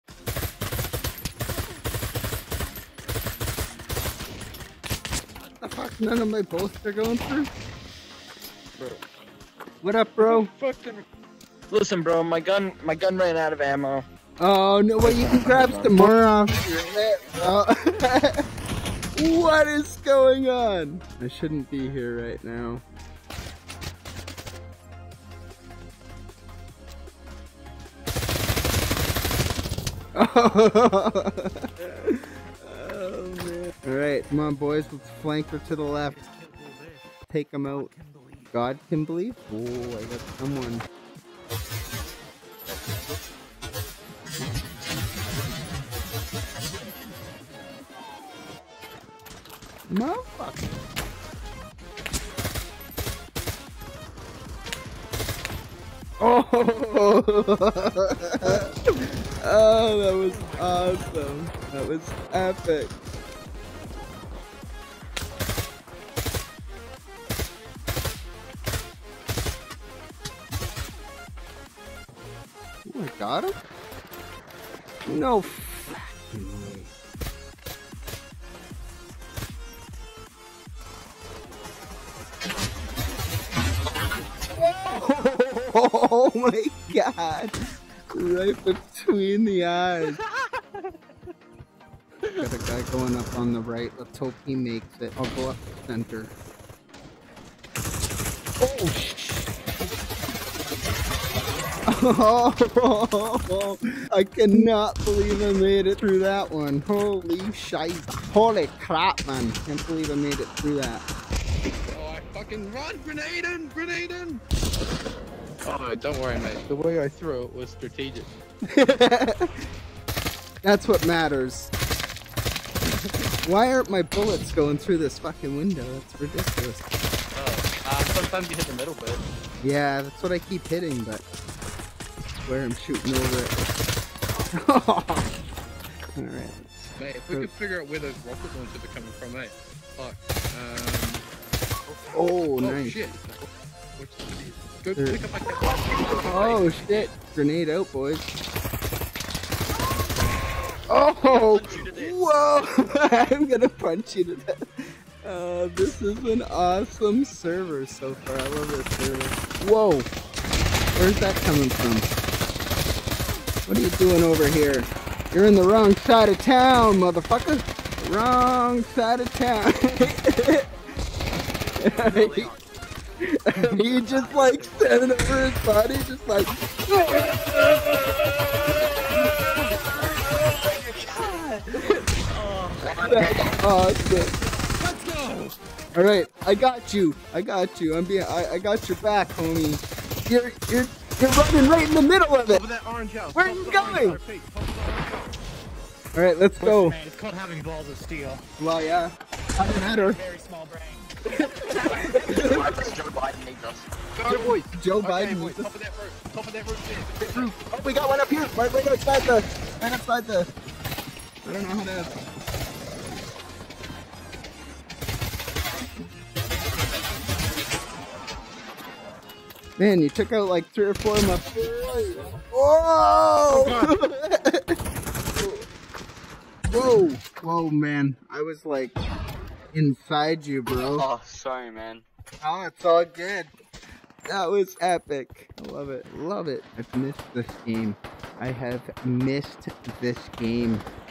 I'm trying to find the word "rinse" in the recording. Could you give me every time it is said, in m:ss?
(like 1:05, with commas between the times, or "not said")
not said.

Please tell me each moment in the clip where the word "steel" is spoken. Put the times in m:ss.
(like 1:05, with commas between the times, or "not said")
3:17.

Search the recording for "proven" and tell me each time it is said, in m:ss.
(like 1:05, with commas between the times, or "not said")
not said.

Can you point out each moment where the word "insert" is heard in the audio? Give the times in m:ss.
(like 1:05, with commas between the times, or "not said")
not said.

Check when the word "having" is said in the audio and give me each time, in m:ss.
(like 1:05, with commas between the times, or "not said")
3:17.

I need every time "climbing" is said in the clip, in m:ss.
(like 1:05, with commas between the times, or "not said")
not said.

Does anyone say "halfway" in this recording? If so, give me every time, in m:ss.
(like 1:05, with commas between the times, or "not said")
not said.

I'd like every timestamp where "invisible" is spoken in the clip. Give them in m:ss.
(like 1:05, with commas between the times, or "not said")
not said.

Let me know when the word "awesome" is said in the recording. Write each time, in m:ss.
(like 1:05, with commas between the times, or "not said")
1:00, 2:36.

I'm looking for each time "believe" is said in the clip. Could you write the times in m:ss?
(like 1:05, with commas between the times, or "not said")
0:39, 1:45, 1:49.